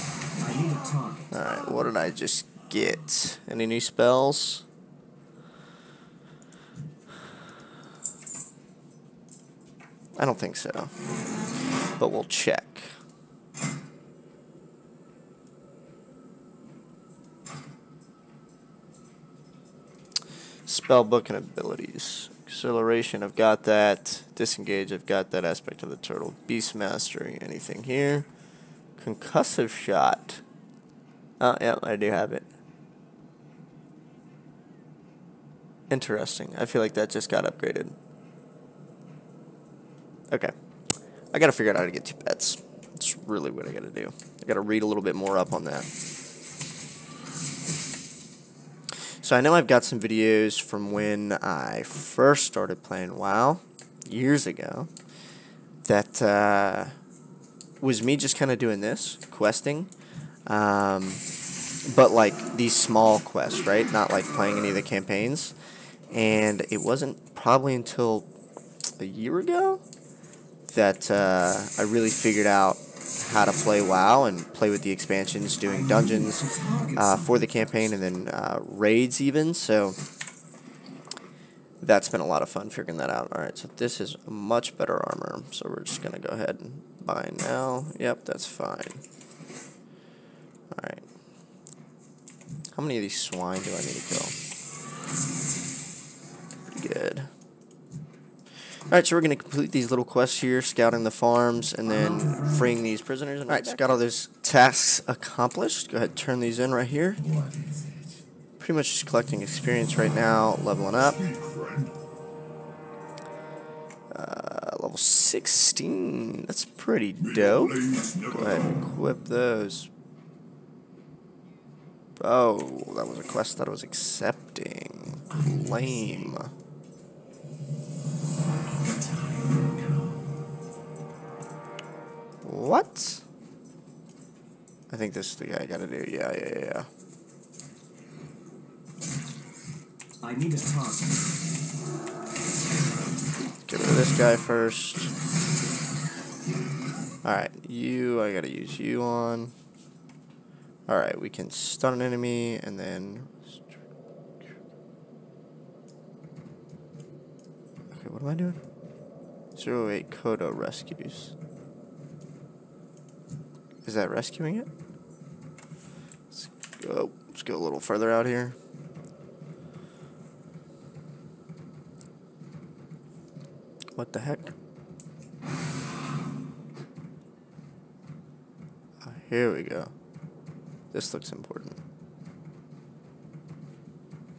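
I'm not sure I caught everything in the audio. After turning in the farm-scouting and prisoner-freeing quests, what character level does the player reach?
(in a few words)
16.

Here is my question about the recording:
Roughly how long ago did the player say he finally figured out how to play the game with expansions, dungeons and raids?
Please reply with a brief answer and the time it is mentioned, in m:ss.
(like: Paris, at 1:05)
a year ago, at 1:08.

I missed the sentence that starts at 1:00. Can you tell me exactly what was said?
Um, but like these small quests, right?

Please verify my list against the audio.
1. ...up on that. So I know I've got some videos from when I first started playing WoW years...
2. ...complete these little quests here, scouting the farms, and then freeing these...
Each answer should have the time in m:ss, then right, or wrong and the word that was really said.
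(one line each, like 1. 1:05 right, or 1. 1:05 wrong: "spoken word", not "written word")
1. 0:45 right
2. 1:39 right.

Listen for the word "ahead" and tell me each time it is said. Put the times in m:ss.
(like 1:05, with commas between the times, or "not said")
1:26, 1:45, 1:58.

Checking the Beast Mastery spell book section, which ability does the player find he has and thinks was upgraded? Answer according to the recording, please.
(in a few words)
Concussive Shot.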